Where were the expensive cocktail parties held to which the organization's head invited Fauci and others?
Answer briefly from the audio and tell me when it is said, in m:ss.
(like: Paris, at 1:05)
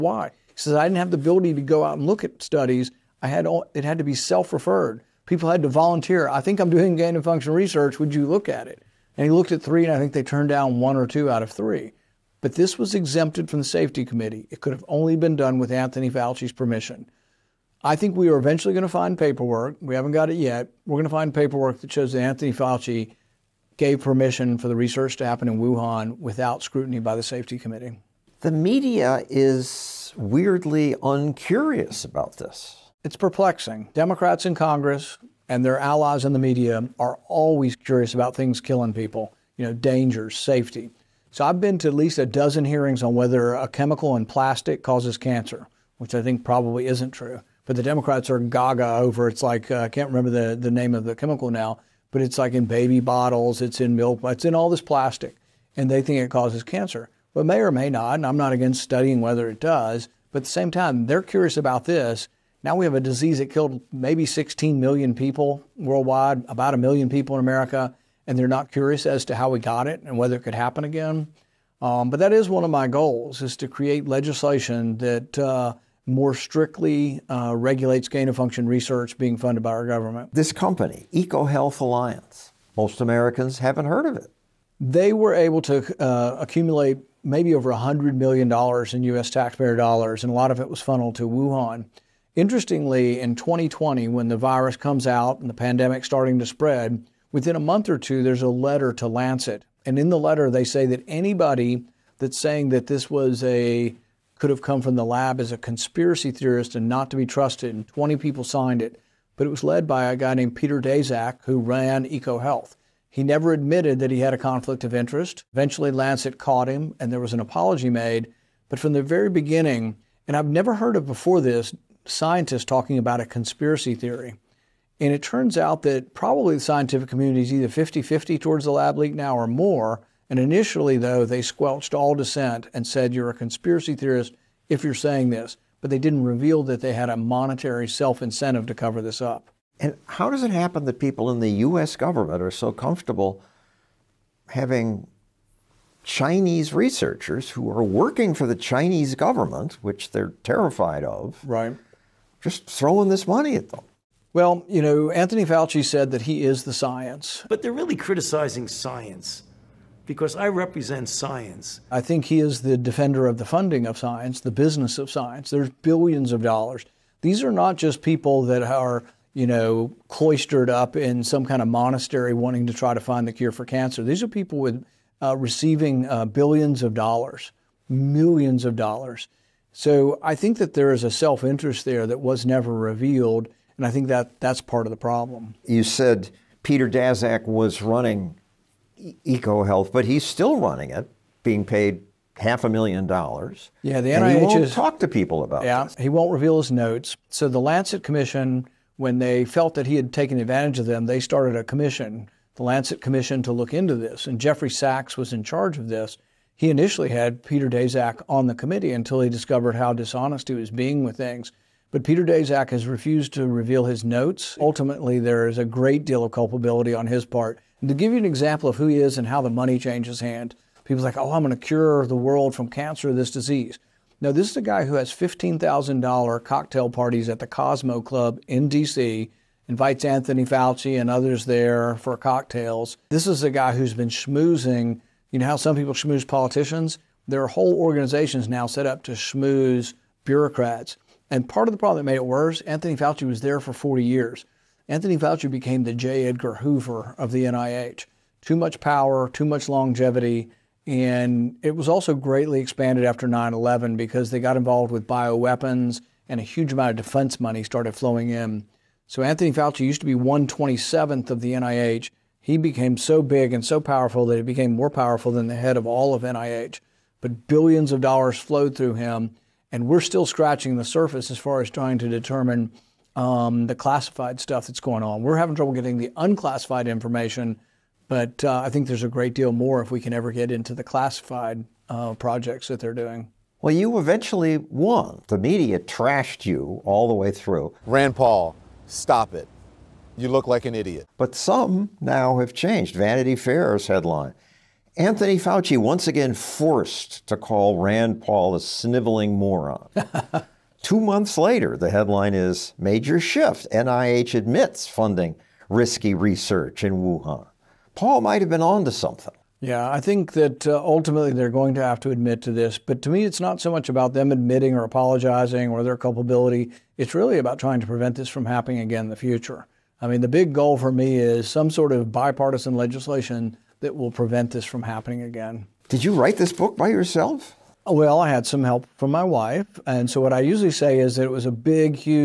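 Cosmos Club, at 3:47.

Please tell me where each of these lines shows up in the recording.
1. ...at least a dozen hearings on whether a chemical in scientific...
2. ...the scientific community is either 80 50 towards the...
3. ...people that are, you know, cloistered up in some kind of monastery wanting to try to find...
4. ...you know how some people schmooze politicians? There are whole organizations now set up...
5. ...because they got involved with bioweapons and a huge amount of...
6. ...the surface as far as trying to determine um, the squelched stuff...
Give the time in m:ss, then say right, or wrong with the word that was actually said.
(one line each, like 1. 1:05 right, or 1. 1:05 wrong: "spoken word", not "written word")
1. 0:41 wrong: "plastic", not "scientific"
2. 2:06 wrong: "50", not "80"
3. 2:48 right
4. 3:55 right
5. 4:13 right
6. 4:30 wrong: "classified", not "squelched".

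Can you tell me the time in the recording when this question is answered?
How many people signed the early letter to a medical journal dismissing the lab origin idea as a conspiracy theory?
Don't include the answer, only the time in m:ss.
1:47.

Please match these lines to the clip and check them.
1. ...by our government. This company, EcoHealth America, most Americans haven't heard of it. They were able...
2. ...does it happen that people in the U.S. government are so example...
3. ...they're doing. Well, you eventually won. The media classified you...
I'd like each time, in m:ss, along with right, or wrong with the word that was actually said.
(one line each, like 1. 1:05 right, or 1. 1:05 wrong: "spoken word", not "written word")
1. 1:19 wrong: "Alliance", not "America"
2. 2:20 wrong: "comfortable", not "example"
3. 4:42 wrong: "trashed", not "classified".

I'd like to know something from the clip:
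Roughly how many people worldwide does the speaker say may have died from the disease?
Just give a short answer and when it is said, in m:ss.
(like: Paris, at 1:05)
16 million, at 1:04.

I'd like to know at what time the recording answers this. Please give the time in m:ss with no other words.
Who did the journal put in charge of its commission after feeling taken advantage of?
3:24.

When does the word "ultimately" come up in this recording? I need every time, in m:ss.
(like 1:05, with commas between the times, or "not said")
3:34, 5:10.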